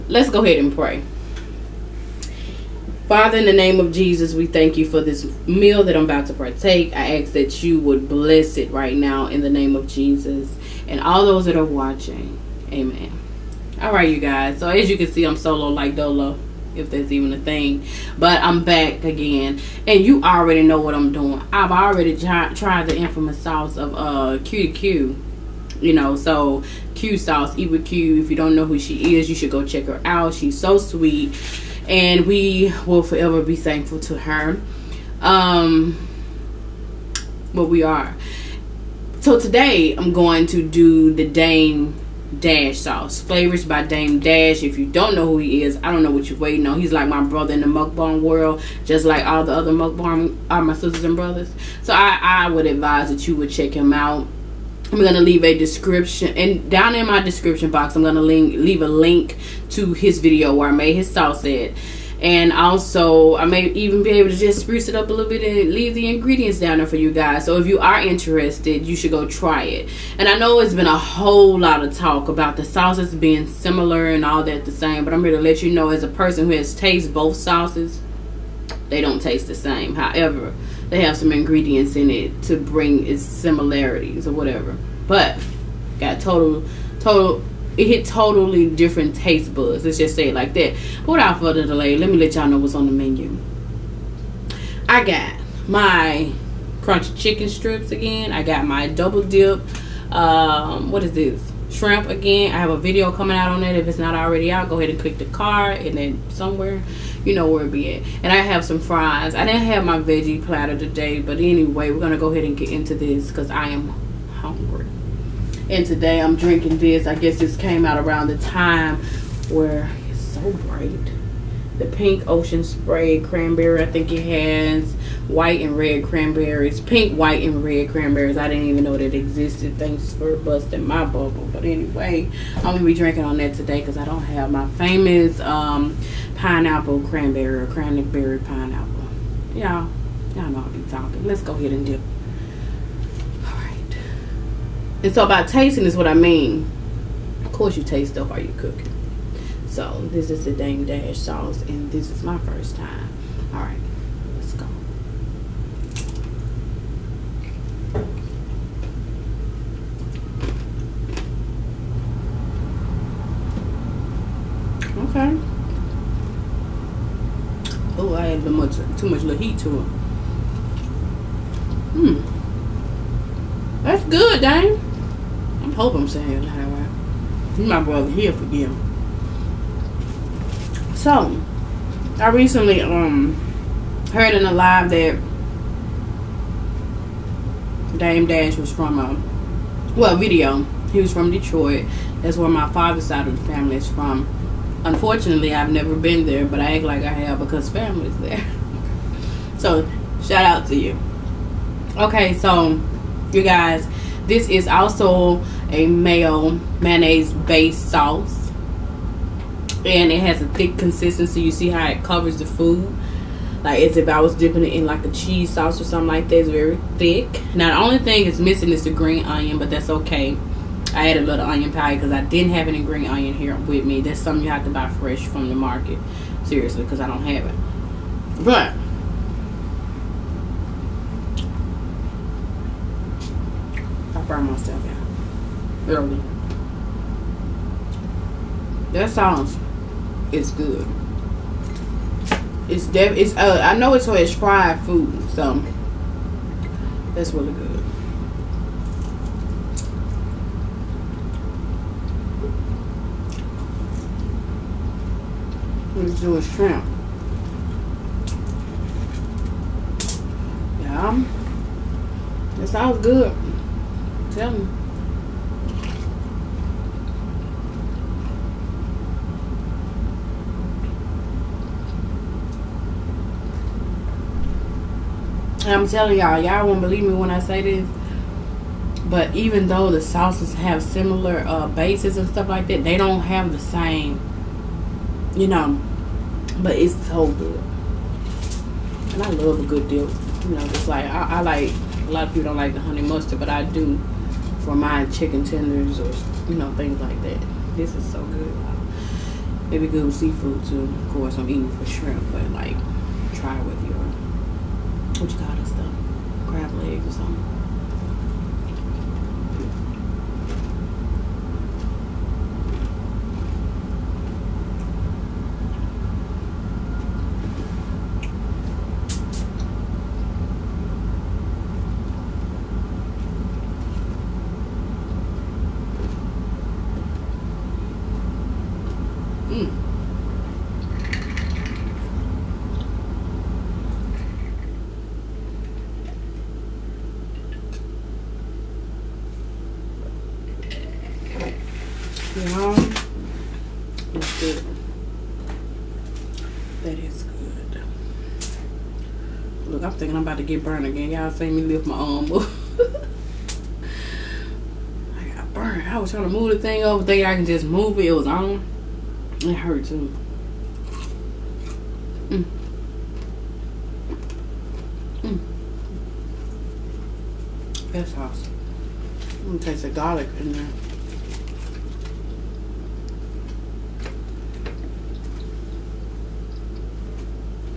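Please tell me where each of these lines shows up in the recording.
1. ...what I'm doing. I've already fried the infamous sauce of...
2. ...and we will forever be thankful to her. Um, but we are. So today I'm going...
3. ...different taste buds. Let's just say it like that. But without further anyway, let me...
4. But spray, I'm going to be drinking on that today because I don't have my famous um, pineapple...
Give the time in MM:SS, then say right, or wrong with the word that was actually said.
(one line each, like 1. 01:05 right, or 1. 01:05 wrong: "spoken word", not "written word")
1. 00:20 wrong: "tried", not "fried"
2. 00:31 right
3. 01:28 wrong: "delay", not "anyway"
4. 02:11 wrong: "anyway", not "spray".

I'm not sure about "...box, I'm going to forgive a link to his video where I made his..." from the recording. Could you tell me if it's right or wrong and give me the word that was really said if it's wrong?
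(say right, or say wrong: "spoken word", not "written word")
wrong: "leave", not "forgive".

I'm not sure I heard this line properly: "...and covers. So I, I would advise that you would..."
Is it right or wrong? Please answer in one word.
wrong.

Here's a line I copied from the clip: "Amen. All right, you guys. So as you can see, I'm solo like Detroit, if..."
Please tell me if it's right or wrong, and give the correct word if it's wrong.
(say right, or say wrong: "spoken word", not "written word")
wrong: "Dolo", not "Detroit".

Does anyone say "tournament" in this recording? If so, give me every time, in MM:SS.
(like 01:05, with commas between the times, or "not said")
not said.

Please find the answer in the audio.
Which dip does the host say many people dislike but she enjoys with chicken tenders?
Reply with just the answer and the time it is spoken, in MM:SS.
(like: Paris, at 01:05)
honey mustard, at 04:52.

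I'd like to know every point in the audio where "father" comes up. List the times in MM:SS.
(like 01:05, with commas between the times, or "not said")
00:03, 03:12.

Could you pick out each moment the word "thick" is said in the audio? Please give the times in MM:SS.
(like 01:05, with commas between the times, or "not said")
03:30, 03:36.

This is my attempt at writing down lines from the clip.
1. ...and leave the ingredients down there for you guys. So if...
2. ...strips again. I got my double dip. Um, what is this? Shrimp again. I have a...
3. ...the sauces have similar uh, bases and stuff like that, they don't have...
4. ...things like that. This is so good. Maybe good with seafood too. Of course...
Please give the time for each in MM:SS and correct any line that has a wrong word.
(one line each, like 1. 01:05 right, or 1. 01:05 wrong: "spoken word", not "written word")
1. 01:05 right
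2. 01:37 right
3. 04:39 right
4. 04:56 right.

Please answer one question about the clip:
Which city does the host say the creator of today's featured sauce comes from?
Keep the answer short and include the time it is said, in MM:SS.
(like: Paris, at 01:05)
Detroit, at 03:11.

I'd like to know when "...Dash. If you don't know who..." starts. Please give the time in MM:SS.
00:44.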